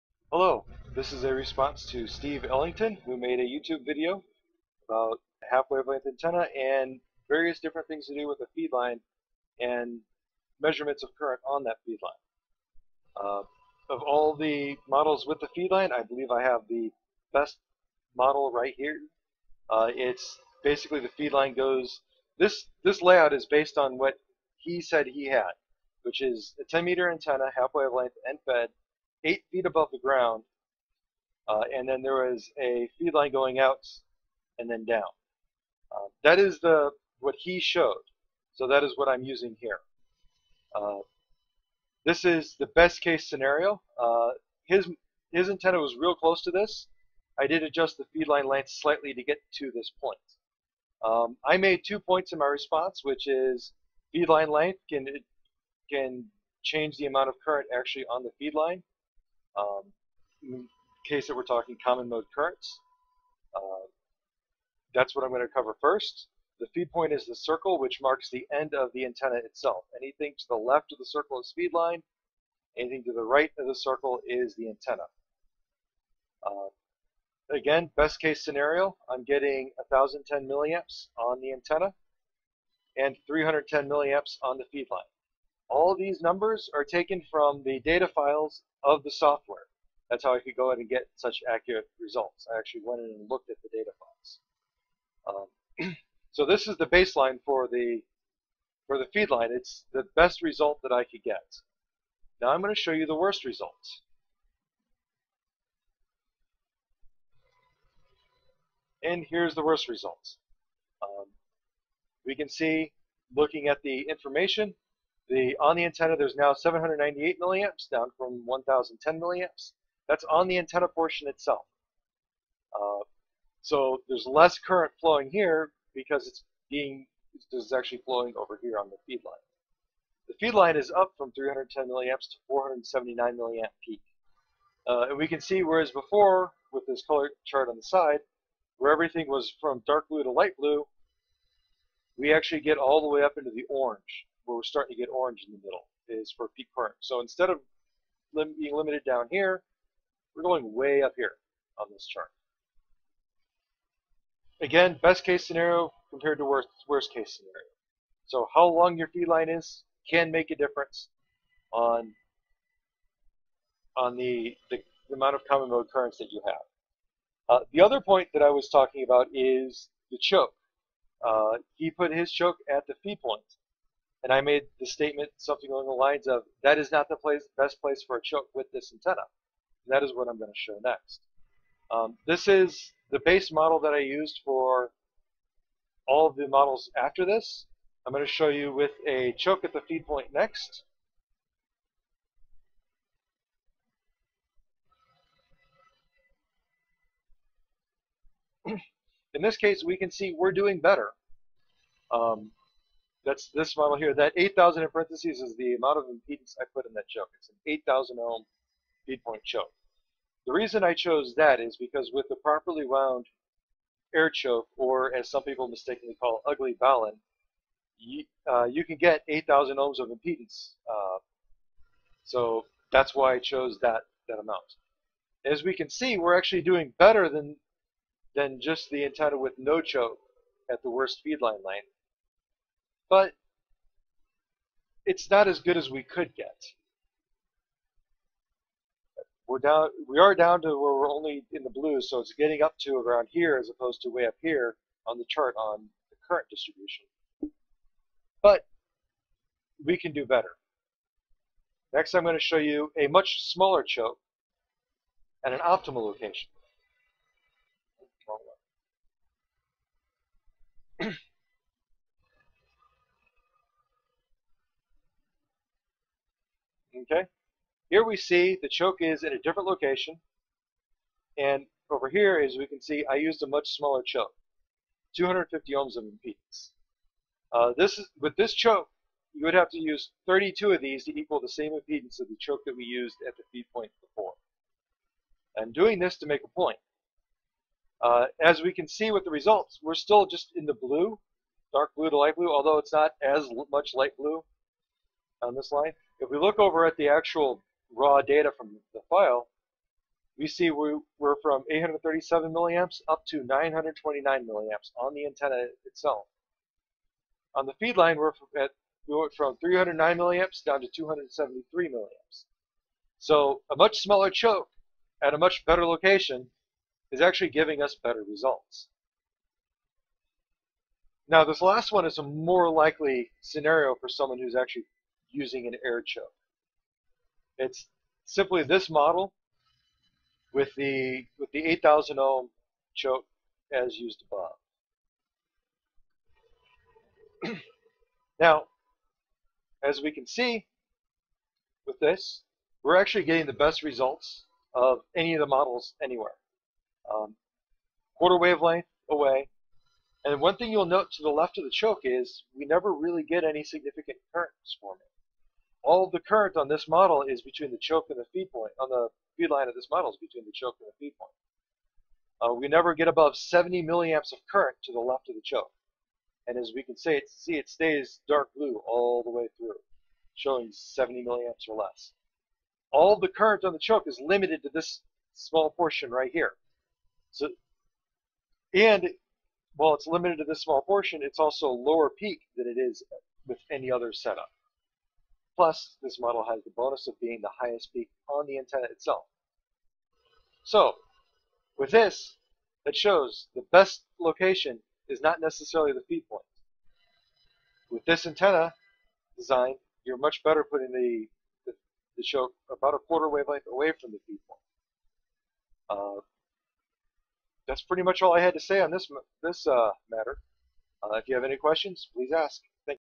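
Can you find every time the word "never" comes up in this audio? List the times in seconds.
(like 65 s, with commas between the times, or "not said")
352 s, 362 s.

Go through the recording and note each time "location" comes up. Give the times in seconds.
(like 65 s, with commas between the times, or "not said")
256 s, 269 s, 315 s, 394 s.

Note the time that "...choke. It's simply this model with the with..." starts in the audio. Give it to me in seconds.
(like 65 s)
326 s.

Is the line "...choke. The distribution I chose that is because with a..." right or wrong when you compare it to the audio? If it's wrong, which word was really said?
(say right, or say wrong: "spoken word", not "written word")
wrong: "reason", not "distribution".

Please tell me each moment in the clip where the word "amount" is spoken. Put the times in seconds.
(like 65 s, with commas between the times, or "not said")
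57 s, 165 s, 205 s, 224 s.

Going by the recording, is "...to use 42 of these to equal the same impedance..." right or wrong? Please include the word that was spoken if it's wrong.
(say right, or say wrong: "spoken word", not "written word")
wrong: "32", not "42".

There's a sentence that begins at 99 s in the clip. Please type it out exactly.
It's the best result that I could get.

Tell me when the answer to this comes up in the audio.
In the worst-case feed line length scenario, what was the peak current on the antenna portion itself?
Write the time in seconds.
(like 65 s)
116 s.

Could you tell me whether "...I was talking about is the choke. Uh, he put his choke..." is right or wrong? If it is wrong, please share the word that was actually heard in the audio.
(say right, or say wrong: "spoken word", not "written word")
right.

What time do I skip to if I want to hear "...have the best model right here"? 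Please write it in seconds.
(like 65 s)
16 s.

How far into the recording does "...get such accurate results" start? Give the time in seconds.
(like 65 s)
90 s.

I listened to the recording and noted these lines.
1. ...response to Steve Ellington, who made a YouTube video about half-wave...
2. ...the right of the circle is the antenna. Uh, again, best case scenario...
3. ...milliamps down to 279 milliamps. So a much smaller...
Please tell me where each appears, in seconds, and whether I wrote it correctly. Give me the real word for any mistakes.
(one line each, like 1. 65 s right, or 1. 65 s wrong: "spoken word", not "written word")
1. 1 s right
2. 73 s right
3. 310 s wrong: "273", not "279".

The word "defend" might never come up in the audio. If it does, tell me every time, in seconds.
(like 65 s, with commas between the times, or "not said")
not said.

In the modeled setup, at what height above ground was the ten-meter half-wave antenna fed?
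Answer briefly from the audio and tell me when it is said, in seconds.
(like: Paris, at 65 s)
8 feet, at 29 s.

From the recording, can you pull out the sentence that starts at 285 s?
I'm doing this to make a point.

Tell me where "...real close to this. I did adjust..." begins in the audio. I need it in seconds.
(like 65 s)
45 s.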